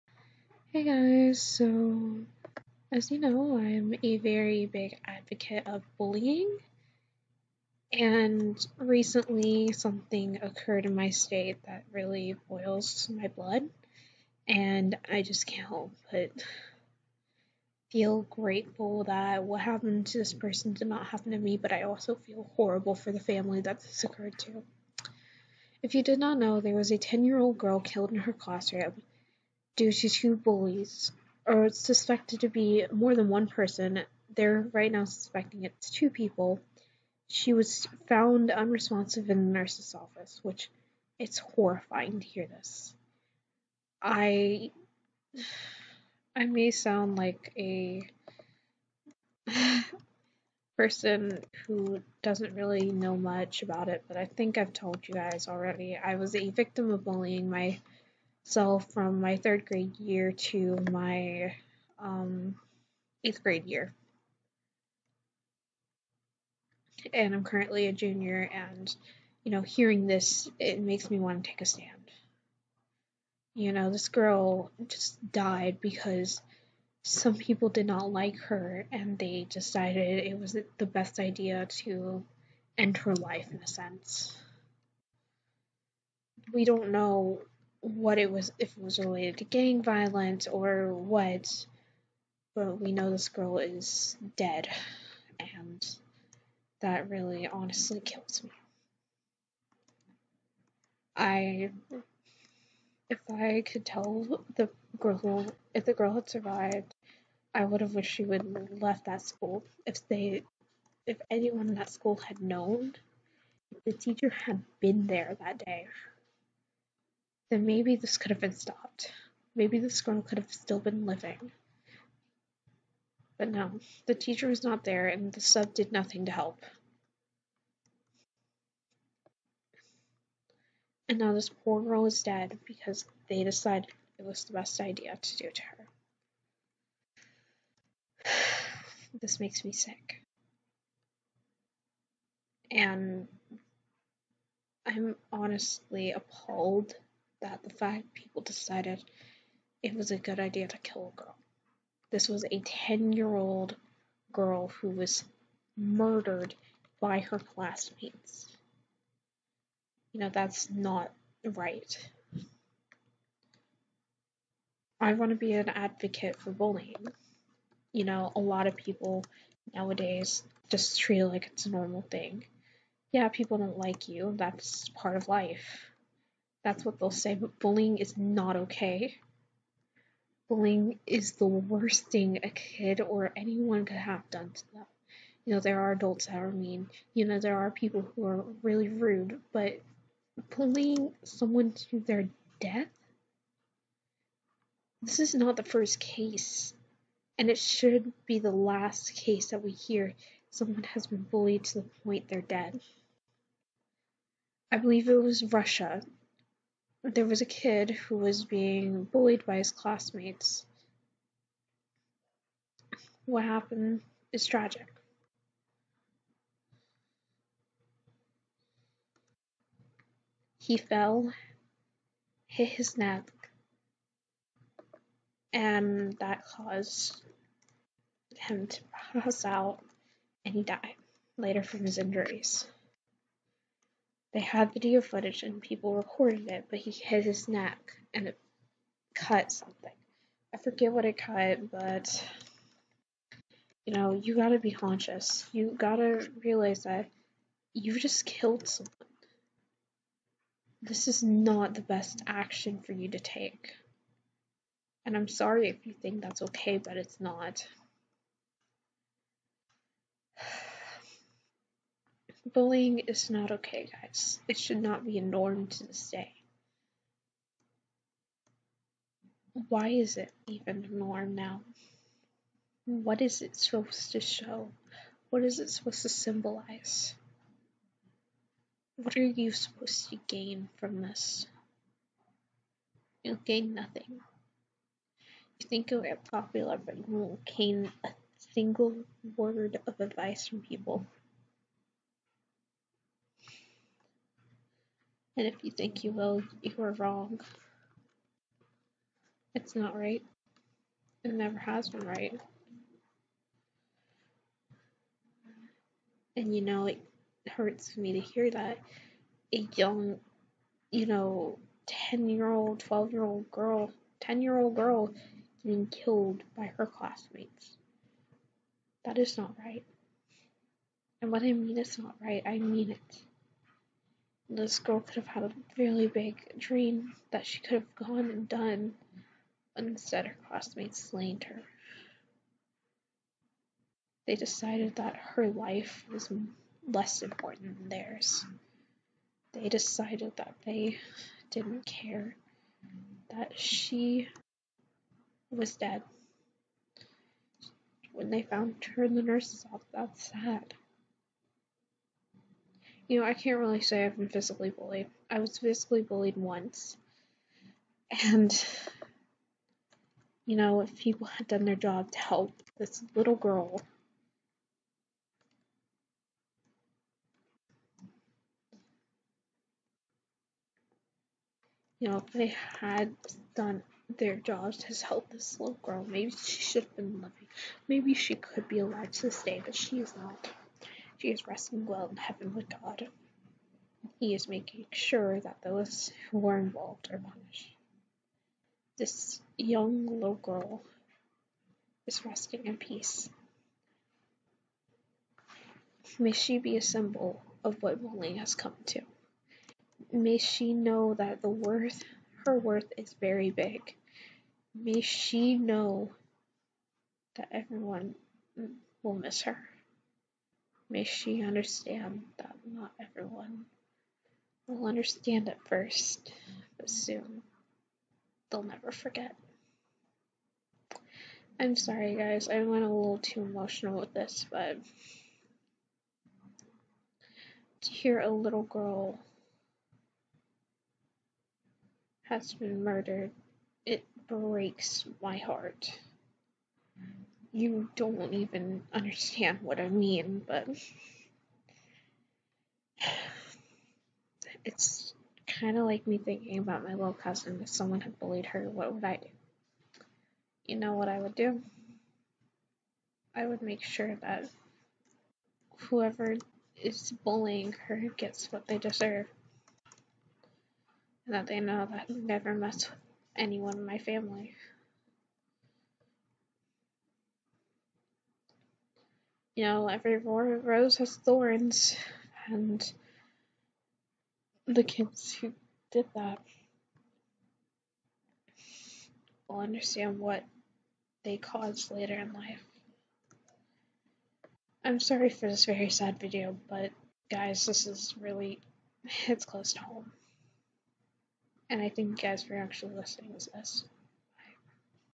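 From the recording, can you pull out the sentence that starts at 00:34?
They're right now suspecting it's two people.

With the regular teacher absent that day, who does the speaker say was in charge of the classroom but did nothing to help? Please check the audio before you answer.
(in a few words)
the sub.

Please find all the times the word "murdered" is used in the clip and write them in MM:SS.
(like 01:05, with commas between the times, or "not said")
02:35, 07:12.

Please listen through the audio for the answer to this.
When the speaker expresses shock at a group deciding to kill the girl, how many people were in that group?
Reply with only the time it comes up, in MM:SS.
02:27.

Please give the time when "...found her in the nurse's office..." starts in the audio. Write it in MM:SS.
05:48.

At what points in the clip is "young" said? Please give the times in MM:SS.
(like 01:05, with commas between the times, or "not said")
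05:09, 06:29.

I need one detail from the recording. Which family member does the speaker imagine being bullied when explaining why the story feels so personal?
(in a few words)
little cousin.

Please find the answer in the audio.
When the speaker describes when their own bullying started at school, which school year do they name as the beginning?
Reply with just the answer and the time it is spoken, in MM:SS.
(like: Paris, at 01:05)
third grade, at 00:59.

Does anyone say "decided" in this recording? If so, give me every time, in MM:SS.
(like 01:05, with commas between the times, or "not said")
01:19, 02:13, 02:28, 05:34, 05:39.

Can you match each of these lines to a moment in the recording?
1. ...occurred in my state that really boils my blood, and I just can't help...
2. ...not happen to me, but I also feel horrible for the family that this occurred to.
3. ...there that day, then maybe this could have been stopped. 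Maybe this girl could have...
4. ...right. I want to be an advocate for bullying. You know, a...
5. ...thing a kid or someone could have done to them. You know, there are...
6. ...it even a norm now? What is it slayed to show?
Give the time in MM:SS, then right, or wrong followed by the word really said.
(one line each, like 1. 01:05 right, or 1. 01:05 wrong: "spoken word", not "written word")
1. 00:10 right
2. 00:20 right
3. 01:55 right
4. 02:41 right
5. 03:02 wrong: "anyone", not "someone"
6. 04:30 wrong: "supposed", not "slayed".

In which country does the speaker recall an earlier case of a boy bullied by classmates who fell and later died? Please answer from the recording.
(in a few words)
Russia.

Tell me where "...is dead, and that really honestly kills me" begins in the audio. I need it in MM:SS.
01:33.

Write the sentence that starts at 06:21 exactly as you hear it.
She is resting well in heaven with God, He is making sure that those who were involved are punished.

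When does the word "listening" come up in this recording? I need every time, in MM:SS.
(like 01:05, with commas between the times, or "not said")
08:12.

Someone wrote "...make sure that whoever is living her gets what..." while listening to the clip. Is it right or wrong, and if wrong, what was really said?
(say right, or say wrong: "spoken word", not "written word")
wrong: "bullying", not "living".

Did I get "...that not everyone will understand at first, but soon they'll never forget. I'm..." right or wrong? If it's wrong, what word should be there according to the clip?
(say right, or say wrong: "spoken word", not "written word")
right.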